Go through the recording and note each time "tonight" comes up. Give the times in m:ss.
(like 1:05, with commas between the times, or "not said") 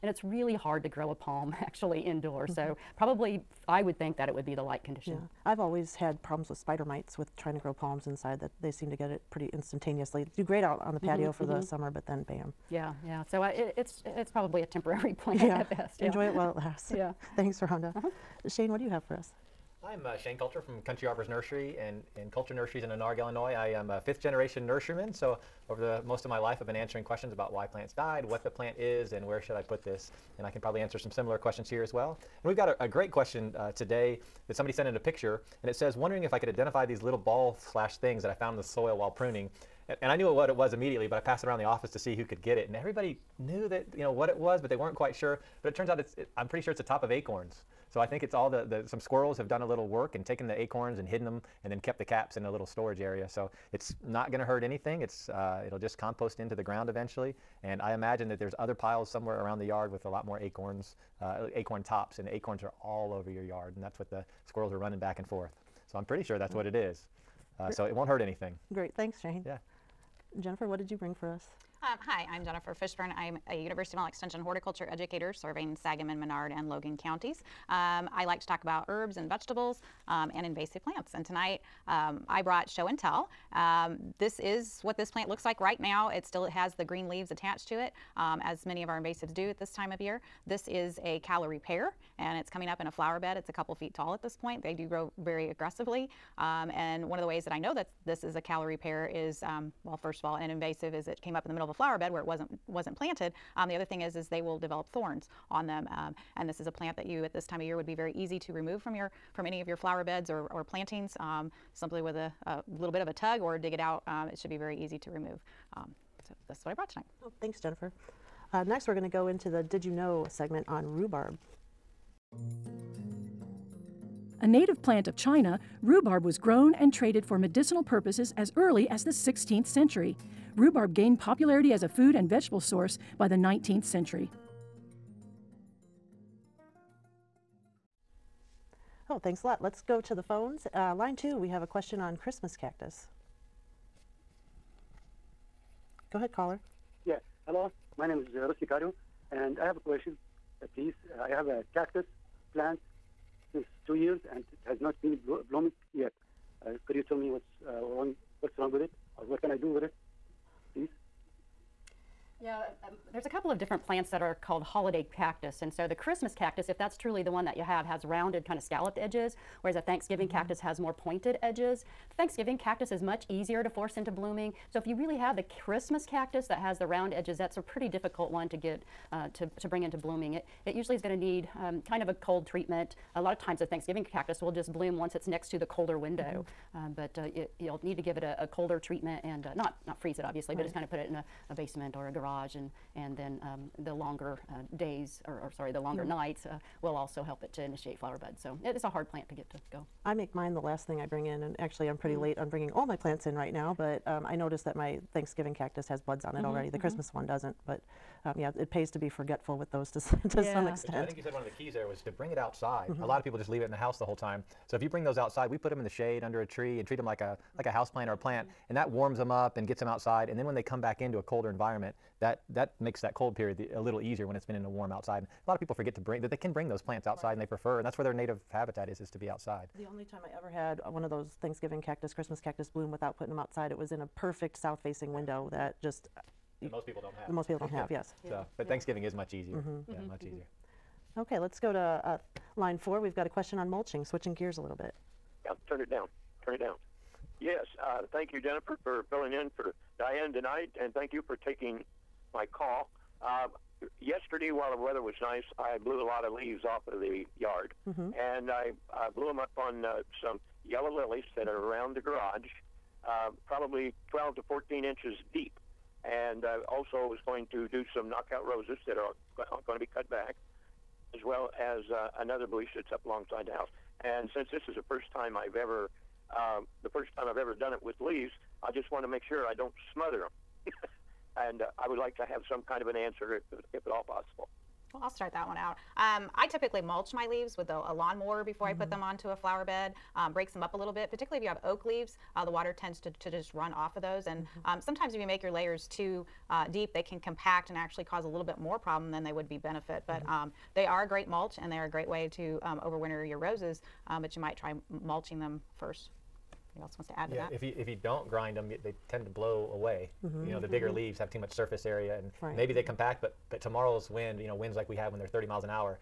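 1:21, 1:56, 4:10.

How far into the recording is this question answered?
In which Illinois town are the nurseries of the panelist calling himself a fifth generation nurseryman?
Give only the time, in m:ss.
0:22.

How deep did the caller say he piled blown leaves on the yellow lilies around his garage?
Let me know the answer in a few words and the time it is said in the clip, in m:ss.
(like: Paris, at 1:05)
12 to 14 inches, at 4:24.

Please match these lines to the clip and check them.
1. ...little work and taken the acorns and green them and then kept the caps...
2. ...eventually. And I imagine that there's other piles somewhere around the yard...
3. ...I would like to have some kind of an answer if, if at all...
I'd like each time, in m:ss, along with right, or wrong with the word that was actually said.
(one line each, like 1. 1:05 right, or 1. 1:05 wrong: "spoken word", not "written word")
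1. 0:49 wrong: "hidden", not "green"
2. 0:56 right
3. 4:41 right.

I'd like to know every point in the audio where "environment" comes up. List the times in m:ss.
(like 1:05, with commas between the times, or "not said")
3:41.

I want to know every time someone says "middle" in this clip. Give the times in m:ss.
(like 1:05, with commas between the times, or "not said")
1:41.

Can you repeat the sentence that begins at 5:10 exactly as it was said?
leaves have too much surface area, and right.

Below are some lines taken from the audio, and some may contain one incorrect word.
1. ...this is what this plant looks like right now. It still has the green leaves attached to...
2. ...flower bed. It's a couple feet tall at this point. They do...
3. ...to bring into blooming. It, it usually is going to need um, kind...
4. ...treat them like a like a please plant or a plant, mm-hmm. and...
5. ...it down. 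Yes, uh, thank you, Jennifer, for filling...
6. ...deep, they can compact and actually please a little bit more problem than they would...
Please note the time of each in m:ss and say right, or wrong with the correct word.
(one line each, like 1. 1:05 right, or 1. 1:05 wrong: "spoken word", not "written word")
1. 1:24 right
2. 1:32 right
3. 2:59 right
4. 3:36 wrong: "house", not "please"
5. 4:06 right
6. 4:56 wrong: "cause", not "please".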